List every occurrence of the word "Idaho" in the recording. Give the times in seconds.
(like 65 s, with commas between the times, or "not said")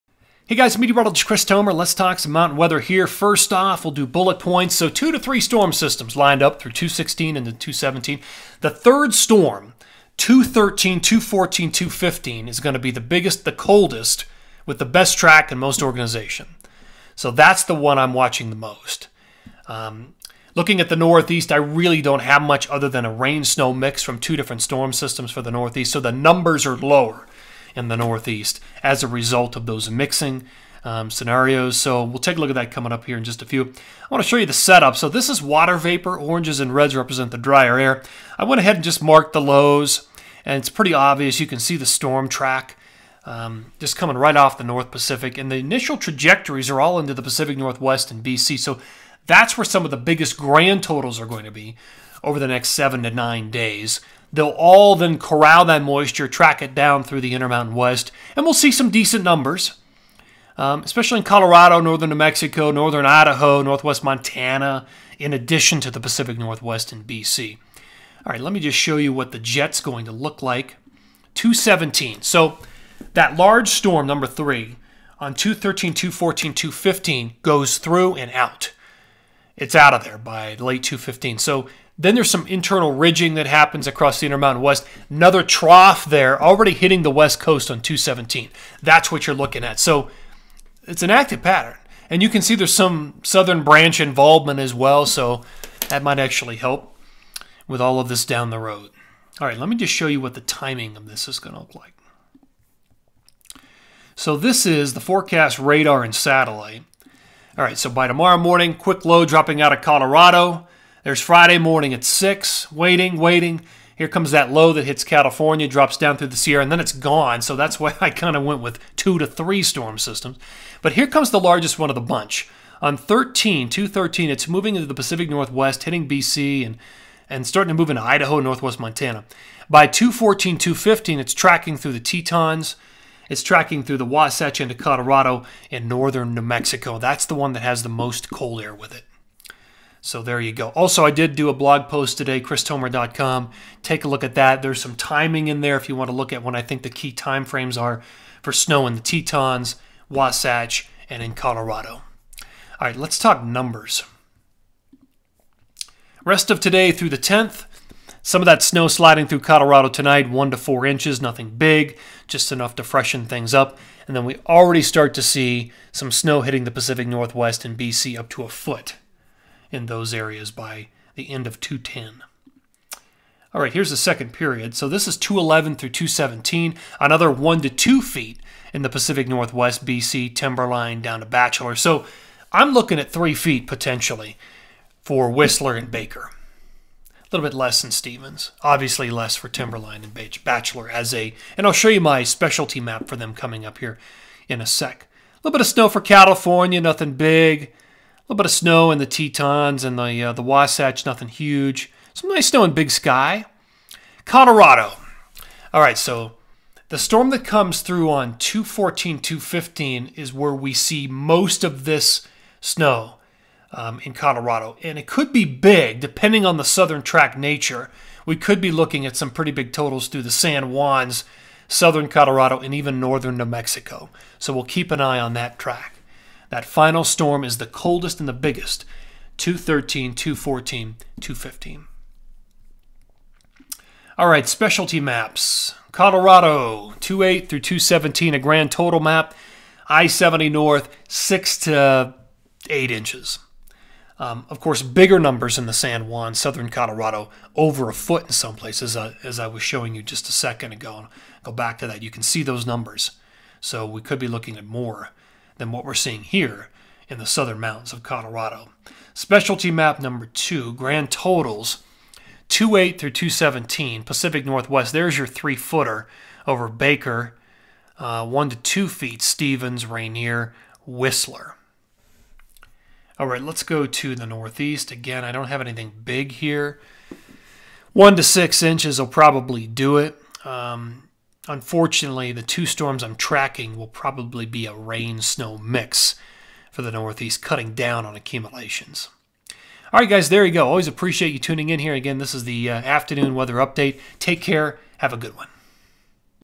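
63 s, 128 s.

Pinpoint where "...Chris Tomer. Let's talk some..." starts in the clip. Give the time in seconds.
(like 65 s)
1 s.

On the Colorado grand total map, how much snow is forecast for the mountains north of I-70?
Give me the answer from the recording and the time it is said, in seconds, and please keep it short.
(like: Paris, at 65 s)
6 to 8 inches, at 241 s.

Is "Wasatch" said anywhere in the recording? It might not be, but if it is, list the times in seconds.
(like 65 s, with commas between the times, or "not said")
134 s, 150 s, 200 s.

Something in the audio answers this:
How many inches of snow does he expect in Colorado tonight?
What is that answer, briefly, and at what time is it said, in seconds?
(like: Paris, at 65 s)
1 to 4 inches, at 160 s.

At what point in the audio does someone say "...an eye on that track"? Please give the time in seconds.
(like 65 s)
224 s.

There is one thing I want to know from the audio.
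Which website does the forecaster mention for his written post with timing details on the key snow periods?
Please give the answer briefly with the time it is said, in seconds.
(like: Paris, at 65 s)
christomer.com, at 142 s.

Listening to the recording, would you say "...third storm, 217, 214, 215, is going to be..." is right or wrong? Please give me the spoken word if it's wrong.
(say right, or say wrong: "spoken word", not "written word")
wrong: "213", not "217".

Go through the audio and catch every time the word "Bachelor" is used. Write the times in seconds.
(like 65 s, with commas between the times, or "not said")
181 s, 190 s.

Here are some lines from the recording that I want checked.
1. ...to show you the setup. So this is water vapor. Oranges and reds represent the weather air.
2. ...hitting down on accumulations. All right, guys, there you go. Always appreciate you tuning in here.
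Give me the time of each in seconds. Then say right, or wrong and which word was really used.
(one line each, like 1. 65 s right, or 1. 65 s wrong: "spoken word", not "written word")
1. 34 s wrong: "drier", not "weather"
2. 287 s wrong: "cutting", not "hitting".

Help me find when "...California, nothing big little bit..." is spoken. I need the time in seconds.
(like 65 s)
196 s.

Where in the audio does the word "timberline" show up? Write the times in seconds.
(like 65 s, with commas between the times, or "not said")
180 s, 189 s.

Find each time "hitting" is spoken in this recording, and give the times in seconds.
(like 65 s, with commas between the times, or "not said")
86 s, 125 s, 166 s.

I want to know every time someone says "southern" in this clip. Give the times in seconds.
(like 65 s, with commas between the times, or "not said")
93 s, 216 s, 221 s, 246 s, 257 s.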